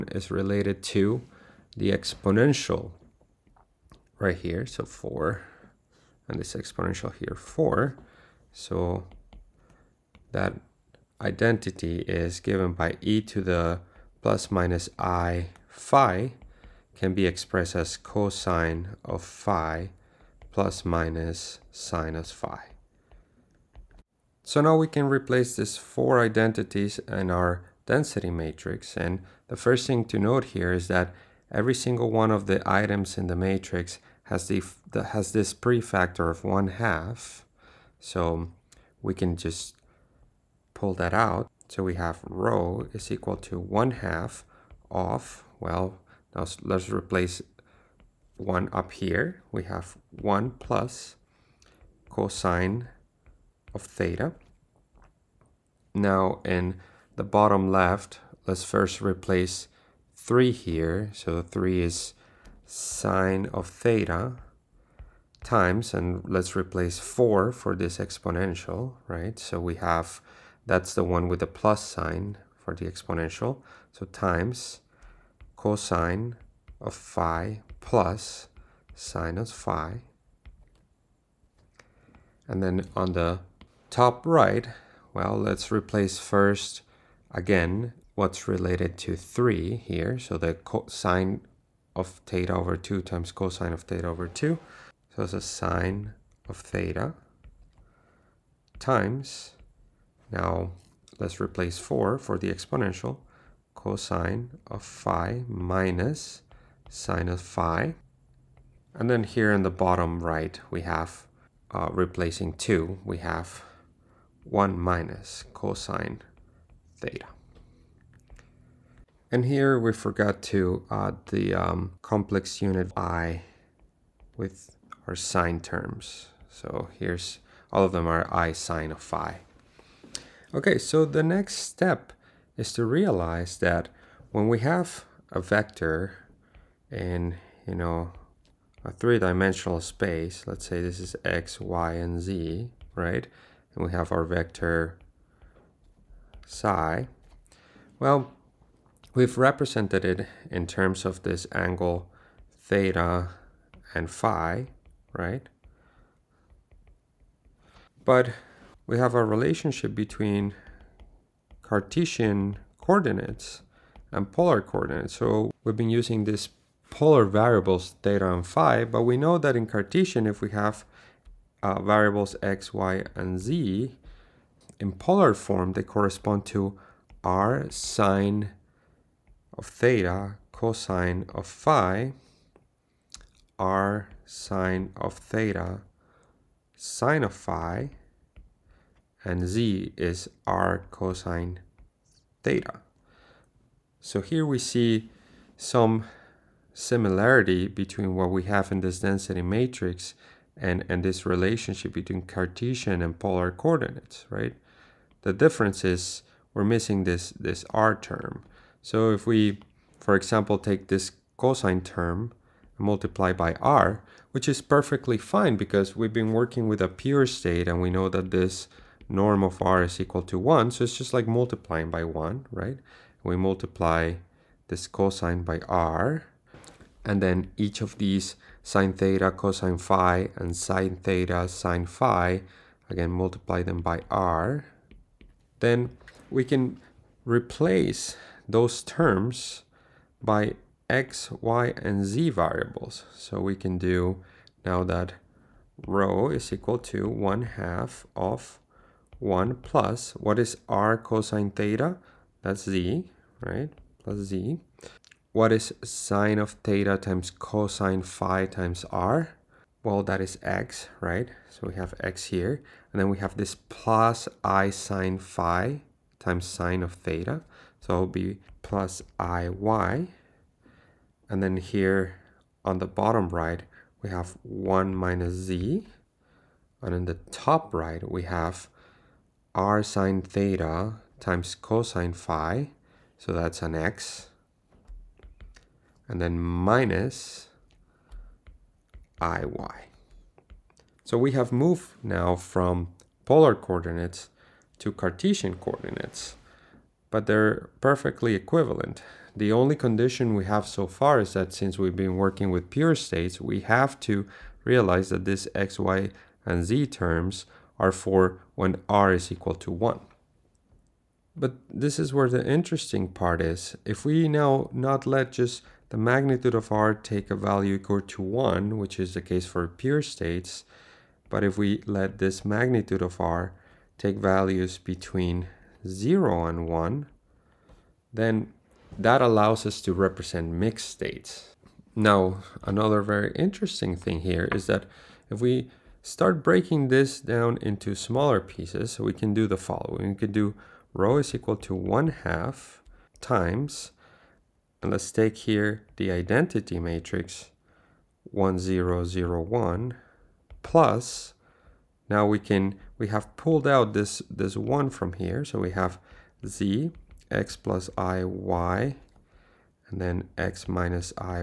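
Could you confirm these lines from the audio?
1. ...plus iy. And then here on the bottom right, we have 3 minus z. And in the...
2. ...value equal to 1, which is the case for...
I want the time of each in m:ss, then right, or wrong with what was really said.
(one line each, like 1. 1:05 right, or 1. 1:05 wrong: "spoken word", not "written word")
1. 4:28 wrong: "1", not "3"
2. 5:17 right.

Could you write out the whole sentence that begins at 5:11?
But this is where the interesting part is.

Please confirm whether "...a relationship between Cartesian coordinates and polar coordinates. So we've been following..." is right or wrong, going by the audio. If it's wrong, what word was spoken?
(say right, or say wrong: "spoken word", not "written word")
wrong: "using", not "following".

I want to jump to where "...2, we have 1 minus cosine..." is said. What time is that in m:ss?
1:52.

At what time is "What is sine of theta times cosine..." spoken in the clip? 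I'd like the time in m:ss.
4:15.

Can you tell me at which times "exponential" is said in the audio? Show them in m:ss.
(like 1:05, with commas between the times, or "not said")
0:01, 0:06, 1:07, 1:12, 1:42.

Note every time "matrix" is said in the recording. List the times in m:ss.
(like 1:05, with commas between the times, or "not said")
0:28, 0:33, 3:19, 5:46.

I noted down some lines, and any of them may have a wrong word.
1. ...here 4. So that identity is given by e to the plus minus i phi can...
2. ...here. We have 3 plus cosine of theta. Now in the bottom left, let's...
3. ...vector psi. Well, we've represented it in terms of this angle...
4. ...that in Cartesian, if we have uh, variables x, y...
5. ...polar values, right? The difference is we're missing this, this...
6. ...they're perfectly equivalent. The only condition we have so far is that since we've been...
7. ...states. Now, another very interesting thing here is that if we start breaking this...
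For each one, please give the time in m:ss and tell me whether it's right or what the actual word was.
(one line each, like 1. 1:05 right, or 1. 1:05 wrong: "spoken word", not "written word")
1. 0:07 right
2. 0:49 wrong: "1", not "3"
3. 2:24 right
4. 2:49 right
5. 3:23 wrong: "coordinates", not "values"
6. 4:57 right
7. 5:30 right.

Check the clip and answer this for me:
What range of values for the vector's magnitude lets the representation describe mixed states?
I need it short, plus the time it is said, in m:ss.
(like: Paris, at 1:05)
between 0 and 1, at 5:24.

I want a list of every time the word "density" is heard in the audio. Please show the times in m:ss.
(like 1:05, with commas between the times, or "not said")
0:27, 3:19.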